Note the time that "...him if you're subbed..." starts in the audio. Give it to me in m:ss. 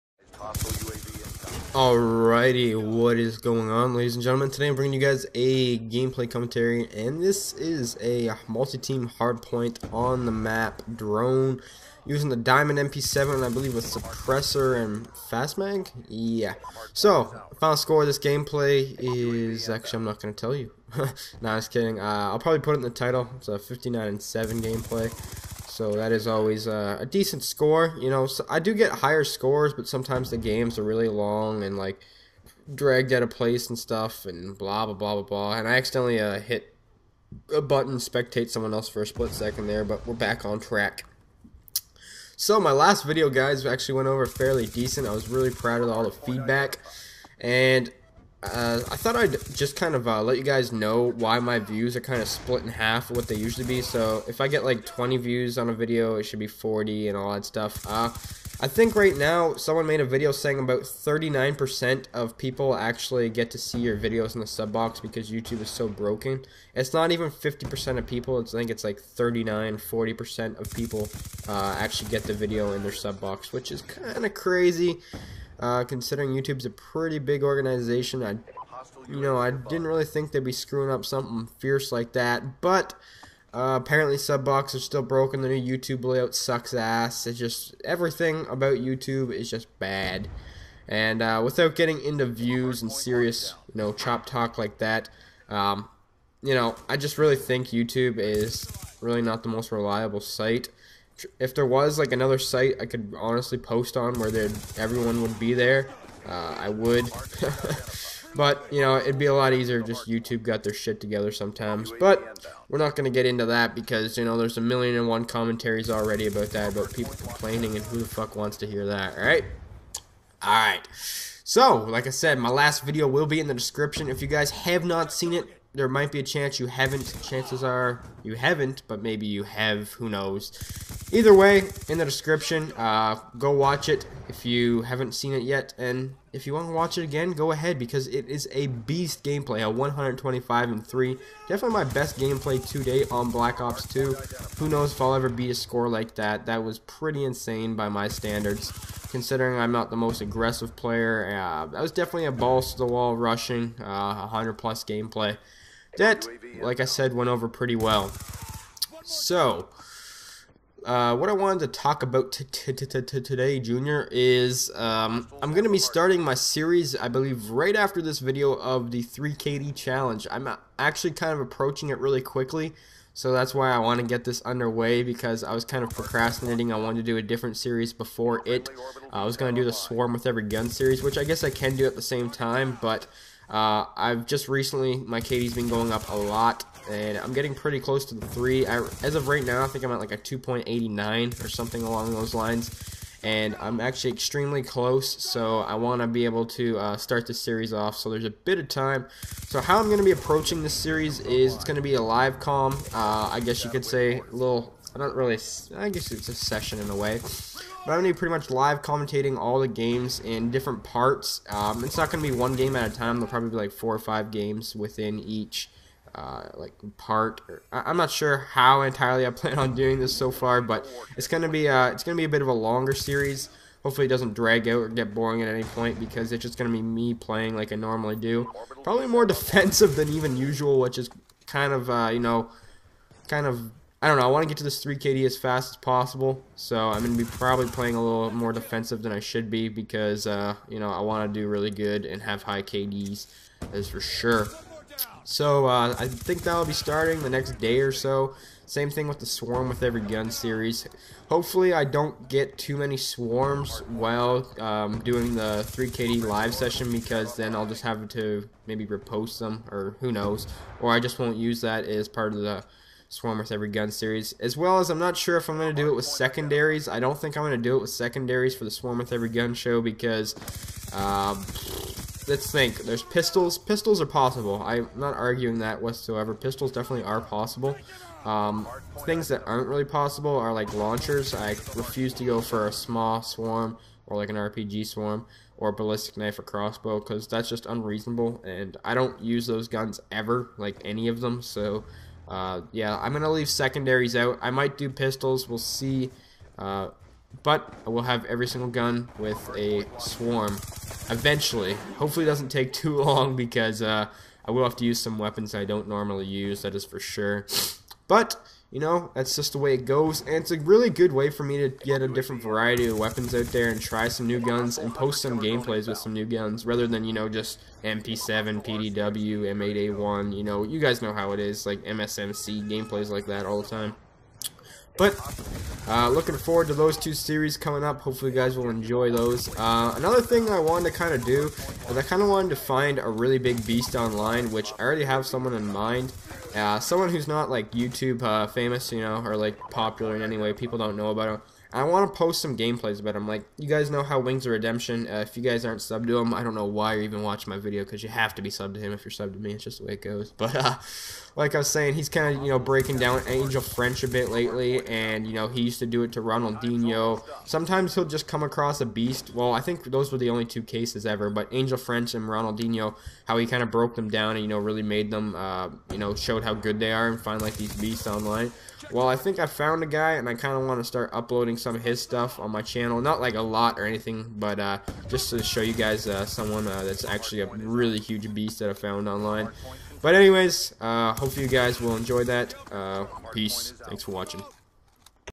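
5:48.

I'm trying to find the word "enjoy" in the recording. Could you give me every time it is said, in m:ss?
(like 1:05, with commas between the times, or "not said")
5:28, 6:21.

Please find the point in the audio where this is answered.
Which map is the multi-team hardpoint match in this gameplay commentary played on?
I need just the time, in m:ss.
0:10.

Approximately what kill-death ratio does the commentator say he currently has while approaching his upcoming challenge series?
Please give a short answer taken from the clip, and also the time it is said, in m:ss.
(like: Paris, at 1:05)
2.89, at 3:10.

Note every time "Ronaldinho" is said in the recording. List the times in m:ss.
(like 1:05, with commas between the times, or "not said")
5:56, 6:02.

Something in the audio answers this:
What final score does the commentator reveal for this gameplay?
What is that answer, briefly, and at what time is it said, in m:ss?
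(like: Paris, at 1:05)
59 and 7, at 0:23.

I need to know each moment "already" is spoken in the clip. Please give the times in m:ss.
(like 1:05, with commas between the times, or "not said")
1:55, 5:34.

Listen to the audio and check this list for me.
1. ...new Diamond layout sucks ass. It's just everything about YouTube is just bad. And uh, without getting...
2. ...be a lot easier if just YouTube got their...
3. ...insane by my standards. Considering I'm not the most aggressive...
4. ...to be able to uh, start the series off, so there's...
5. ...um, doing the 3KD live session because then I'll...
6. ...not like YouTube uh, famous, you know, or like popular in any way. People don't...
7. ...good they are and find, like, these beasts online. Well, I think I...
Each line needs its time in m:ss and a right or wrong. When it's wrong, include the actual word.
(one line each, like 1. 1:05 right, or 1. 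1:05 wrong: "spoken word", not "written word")
1. 1:25 wrong: "YouTube", not "Diamond"
2. 1:49 right
3. 2:27 right
4. 3:16 right
5. 4:14 right
6. 5:37 right
7. 6:06 right.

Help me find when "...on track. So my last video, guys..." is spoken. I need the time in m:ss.
0:40.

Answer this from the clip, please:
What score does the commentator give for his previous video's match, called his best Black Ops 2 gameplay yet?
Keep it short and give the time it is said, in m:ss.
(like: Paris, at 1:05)
125 and 3, at 2:19.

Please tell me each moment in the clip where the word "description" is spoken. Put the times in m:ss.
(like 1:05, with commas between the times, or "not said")
2:03, 2:12.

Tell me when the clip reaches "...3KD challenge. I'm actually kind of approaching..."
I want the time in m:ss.
2:49.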